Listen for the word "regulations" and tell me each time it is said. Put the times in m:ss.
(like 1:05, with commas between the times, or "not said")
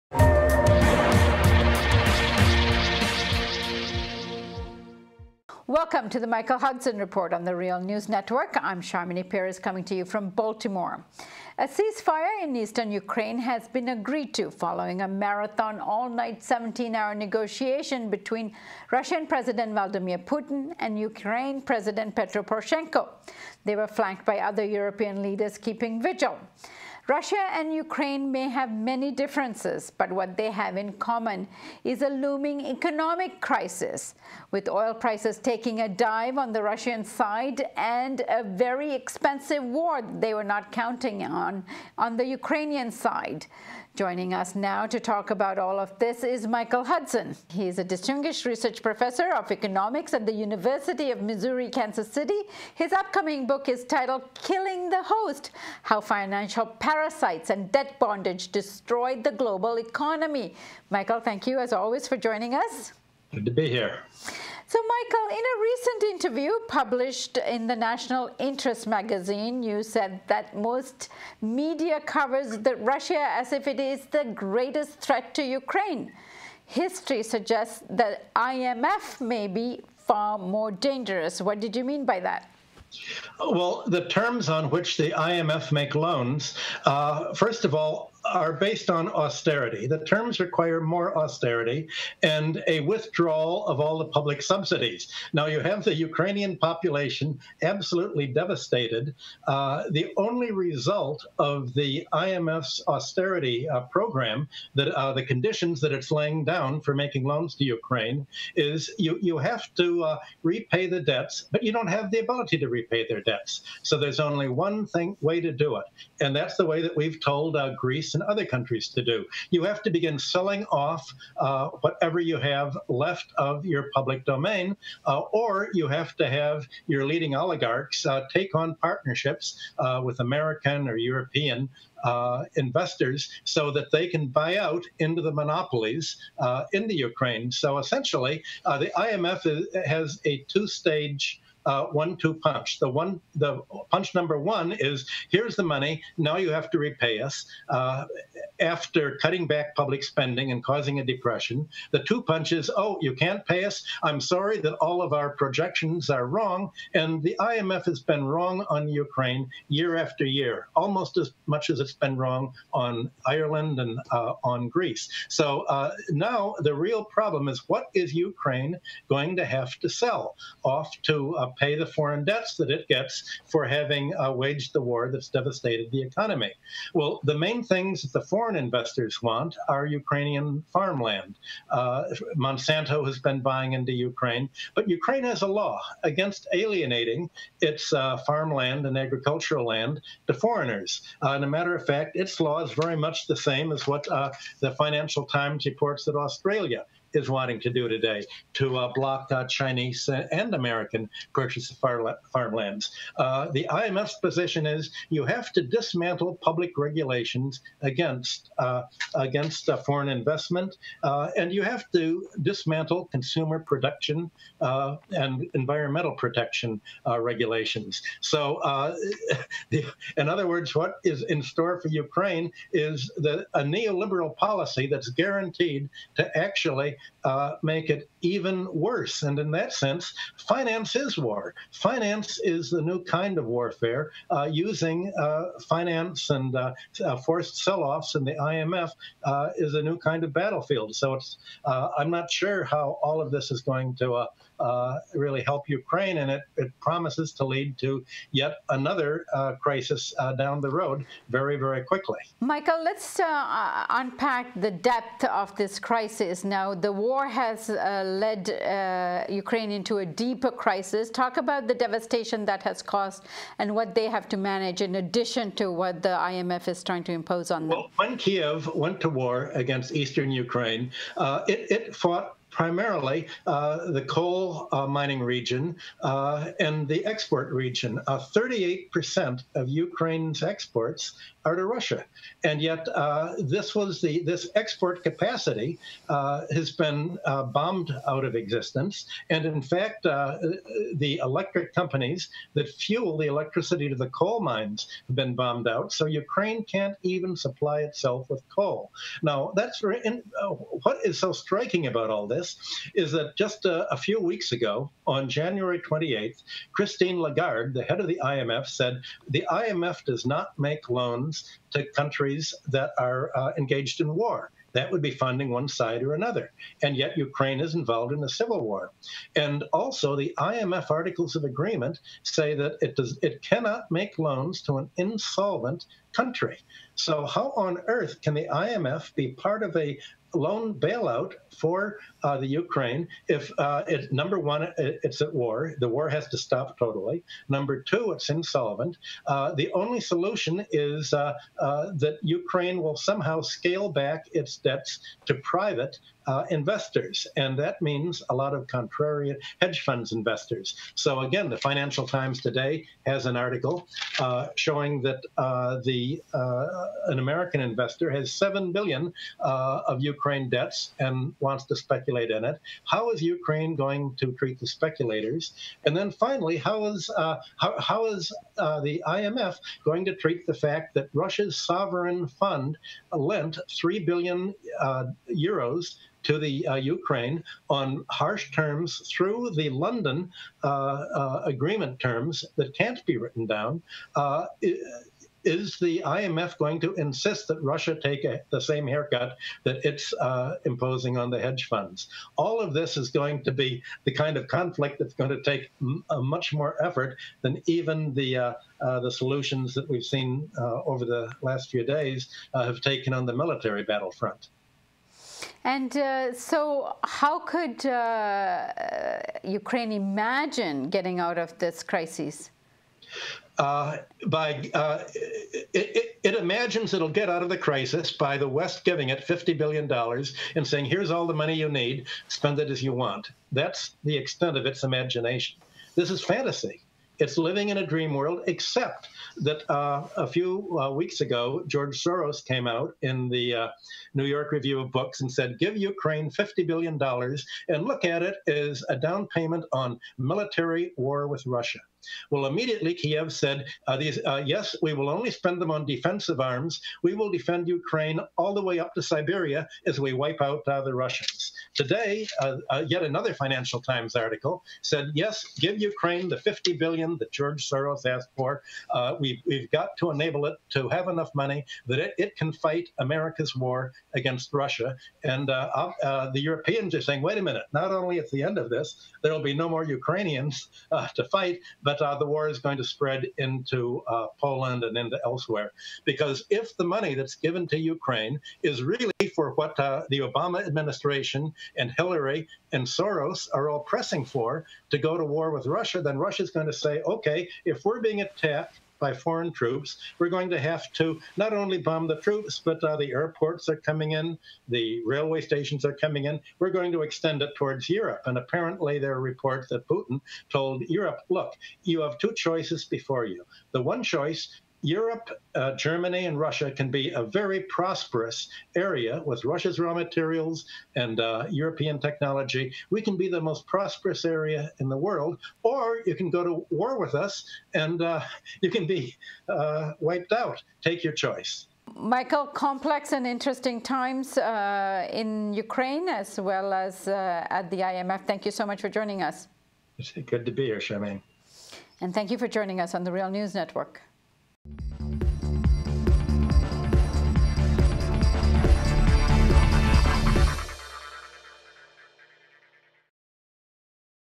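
3:26, 3:37.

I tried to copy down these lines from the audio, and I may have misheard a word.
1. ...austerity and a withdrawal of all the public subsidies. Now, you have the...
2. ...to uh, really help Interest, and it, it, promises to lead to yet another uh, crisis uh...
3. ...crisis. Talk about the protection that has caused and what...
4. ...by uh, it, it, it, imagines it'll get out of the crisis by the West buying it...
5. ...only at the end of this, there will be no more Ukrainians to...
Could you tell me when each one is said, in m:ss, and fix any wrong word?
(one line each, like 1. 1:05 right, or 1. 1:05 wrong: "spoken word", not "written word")
1. 1:31 right
2. 4:03 wrong: "Ukraine", not "Interest"
3. 4:20 wrong: "devastation", not "protection"
4. 6:54 wrong: "giving", not "buying"
5. 7:47 right.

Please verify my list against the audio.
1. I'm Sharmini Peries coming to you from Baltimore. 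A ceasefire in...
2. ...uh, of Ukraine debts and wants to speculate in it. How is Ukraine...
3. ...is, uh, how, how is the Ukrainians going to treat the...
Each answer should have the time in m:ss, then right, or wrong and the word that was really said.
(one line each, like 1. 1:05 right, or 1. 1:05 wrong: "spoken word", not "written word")
1. 0:08 right
2. 5:59 right
3. 6:06 wrong: "IMF", not "Ukrainians".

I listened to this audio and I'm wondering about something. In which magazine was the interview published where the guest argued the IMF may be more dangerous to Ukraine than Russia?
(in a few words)
National Interest.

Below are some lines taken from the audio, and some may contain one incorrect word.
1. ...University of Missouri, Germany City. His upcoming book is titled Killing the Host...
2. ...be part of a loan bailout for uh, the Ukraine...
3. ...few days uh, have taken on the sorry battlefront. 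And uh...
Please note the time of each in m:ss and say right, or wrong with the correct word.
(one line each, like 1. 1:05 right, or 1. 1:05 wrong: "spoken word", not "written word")
1. 0:50 wrong: "Kansas", not "Germany"
2. 5:29 right
3. 6:41 wrong: "military", not "sorry".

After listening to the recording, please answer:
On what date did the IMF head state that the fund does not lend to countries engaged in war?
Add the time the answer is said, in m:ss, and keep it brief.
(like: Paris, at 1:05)
January 28th, at 5:05.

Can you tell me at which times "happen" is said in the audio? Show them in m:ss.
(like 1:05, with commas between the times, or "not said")
not said.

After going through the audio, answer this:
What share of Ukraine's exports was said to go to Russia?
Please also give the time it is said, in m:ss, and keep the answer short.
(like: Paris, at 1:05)
38%, at 4:38.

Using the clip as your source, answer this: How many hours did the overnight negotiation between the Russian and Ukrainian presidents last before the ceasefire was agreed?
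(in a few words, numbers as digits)
17.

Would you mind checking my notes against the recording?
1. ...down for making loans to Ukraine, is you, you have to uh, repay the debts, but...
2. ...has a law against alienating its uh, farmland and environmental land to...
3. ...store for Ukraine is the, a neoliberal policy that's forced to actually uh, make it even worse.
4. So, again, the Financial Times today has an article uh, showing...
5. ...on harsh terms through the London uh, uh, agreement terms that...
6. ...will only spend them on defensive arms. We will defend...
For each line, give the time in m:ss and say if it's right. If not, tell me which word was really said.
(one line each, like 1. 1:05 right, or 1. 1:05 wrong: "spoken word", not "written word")
1. 1:46 right
2. 3:05 wrong: "agricultural", not "environmental"
3. 3:41 wrong: "guaranteed", not "forced"
4. 5:50 right
5. 6:17 right
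6. 7:24 right.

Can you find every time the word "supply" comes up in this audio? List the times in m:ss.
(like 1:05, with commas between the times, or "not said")
4:57.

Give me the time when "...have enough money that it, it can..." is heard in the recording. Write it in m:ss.
7:40.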